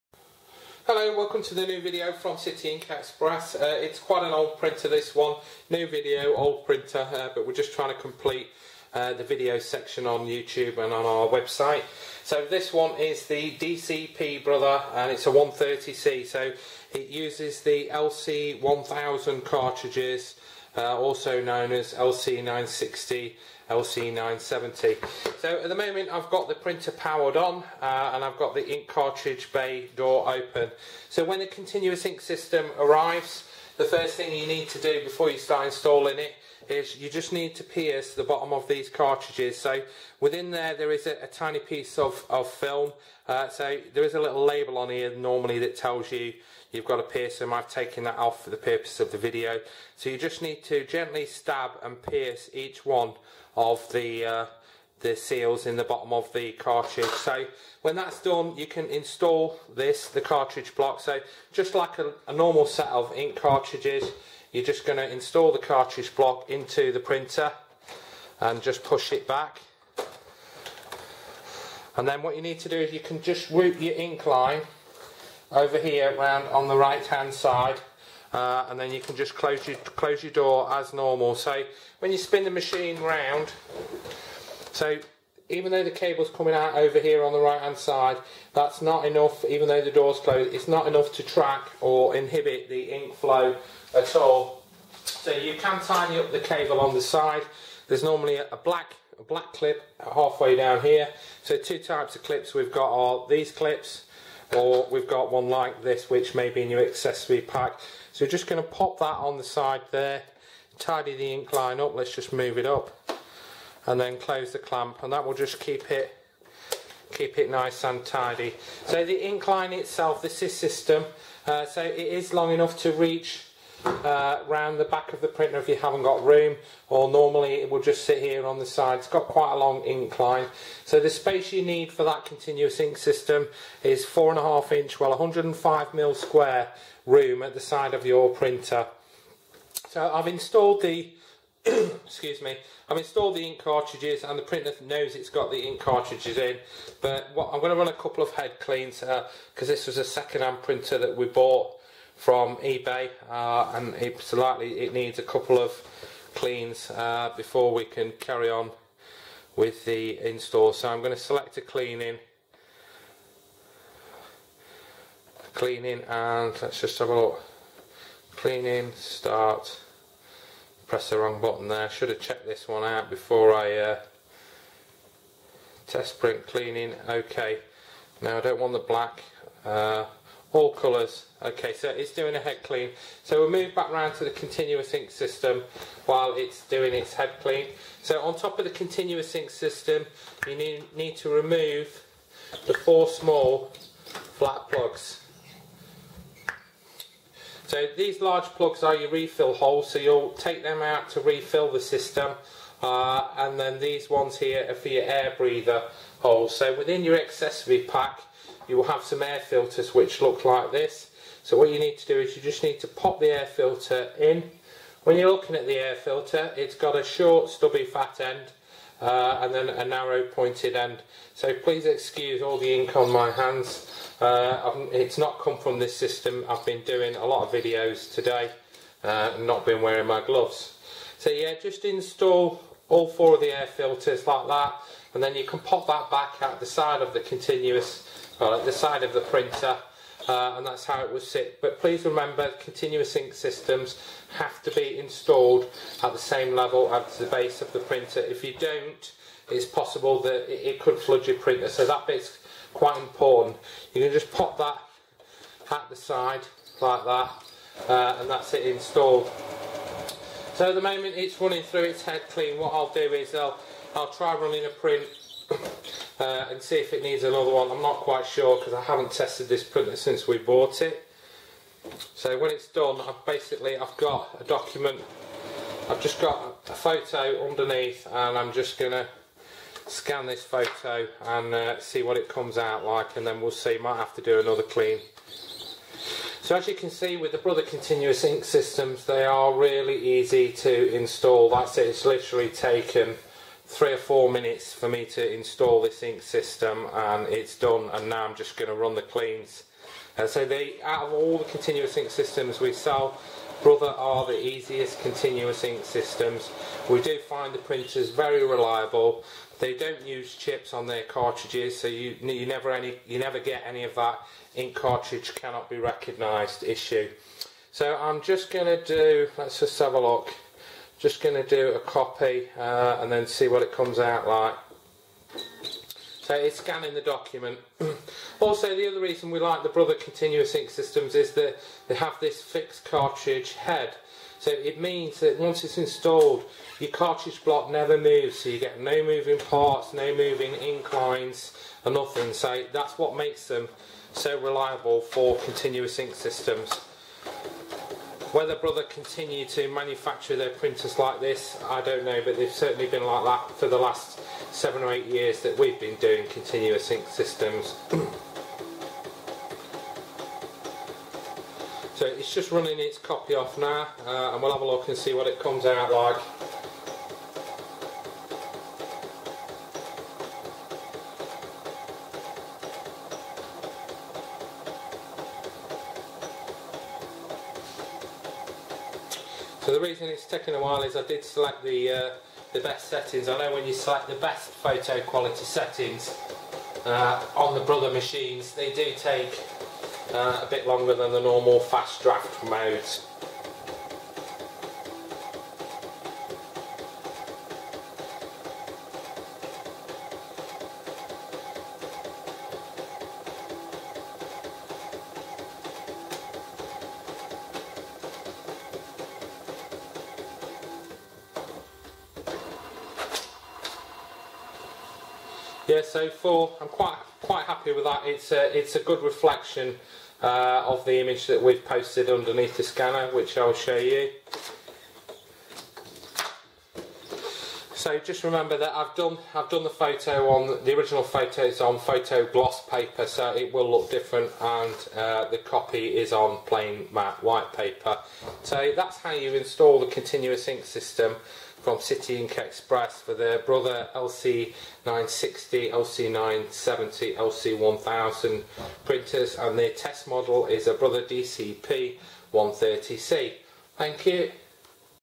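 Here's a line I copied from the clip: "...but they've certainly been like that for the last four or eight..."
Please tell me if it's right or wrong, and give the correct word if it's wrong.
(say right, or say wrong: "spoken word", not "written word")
wrong: "seven", not "four".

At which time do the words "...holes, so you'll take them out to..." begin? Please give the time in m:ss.
3:19.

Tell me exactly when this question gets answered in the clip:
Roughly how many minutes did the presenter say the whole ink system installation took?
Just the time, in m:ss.
4:53.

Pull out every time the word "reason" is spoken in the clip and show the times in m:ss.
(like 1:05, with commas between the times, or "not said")
5:28, 6:19.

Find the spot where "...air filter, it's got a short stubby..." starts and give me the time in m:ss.
3:35.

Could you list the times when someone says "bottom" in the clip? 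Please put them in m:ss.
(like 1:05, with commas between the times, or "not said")
0:38, 0:55.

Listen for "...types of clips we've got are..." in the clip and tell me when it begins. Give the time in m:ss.
1:41.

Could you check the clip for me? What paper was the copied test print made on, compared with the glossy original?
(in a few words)
plain matte white paper.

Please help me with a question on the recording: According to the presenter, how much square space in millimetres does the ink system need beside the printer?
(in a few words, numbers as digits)
105 mm.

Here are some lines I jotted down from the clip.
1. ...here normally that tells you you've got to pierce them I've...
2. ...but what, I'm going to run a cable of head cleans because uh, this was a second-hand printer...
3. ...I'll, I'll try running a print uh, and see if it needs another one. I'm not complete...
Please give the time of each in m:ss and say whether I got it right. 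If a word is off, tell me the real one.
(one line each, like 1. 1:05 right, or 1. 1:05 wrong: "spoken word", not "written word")
1. 0:44 right
2. 2:27 wrong: "couple", not "cable"
3. 4:23 wrong: "quite", not "complete".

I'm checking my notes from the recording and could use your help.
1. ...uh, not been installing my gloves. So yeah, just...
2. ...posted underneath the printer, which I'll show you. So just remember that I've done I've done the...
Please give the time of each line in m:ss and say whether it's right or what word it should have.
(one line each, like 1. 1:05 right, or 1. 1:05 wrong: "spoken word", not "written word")
1. 3:49 wrong: "wearing", not "installing"
2. 7:01 wrong: "scanner", not "printer".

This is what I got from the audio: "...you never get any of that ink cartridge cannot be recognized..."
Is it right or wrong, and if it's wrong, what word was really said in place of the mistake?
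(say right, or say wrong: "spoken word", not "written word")
right.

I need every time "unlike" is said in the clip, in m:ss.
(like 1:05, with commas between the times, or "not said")
not said.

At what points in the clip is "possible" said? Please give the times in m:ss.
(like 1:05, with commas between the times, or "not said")
4:09.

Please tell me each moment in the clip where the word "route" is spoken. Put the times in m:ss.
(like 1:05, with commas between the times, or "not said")
1:13.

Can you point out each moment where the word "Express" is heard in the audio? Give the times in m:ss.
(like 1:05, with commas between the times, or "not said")
0:02, 7:22.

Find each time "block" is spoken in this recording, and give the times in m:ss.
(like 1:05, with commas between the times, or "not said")
1:00, 1:06, 5:37.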